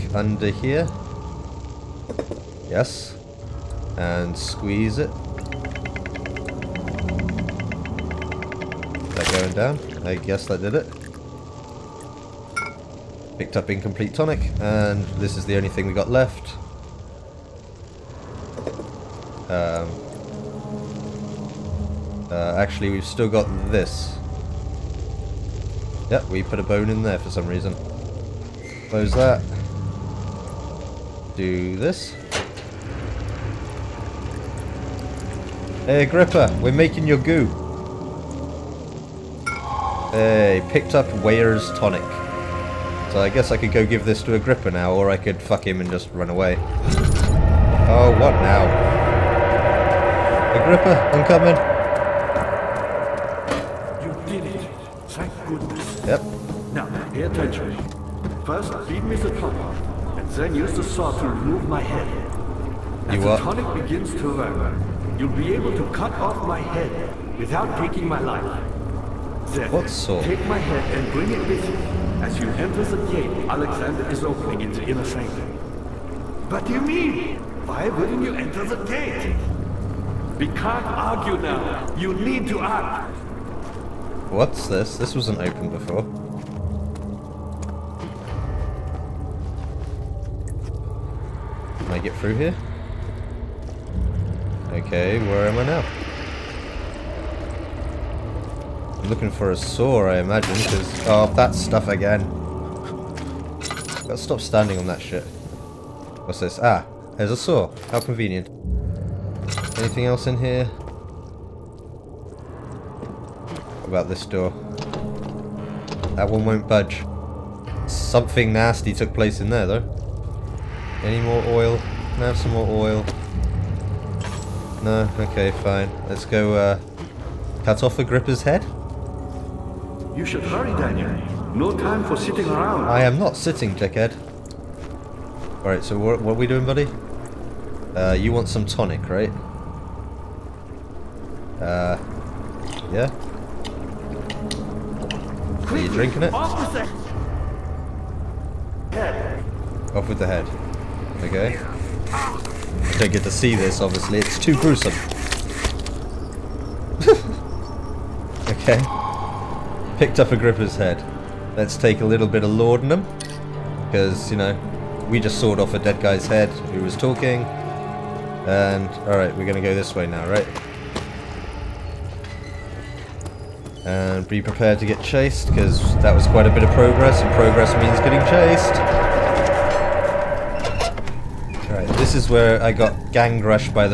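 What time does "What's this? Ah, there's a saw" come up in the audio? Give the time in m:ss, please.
1:46.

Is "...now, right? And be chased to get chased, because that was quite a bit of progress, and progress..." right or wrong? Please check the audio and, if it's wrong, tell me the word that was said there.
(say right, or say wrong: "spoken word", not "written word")
wrong: "prepared", not "chased".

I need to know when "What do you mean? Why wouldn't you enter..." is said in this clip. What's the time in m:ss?
1:16.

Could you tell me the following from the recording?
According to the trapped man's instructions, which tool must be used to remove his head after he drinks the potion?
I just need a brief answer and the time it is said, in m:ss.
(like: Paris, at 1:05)
the saw, at 1:00.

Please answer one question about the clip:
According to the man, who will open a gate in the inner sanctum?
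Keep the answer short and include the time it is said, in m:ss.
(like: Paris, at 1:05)
Alexander, at 1:13.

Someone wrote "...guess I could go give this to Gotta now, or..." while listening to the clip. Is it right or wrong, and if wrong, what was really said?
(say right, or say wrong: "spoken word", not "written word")
wrong: "Agrippa", not "Gotta".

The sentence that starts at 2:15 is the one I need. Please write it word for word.
Alright, so what, what, are we doing, buddy?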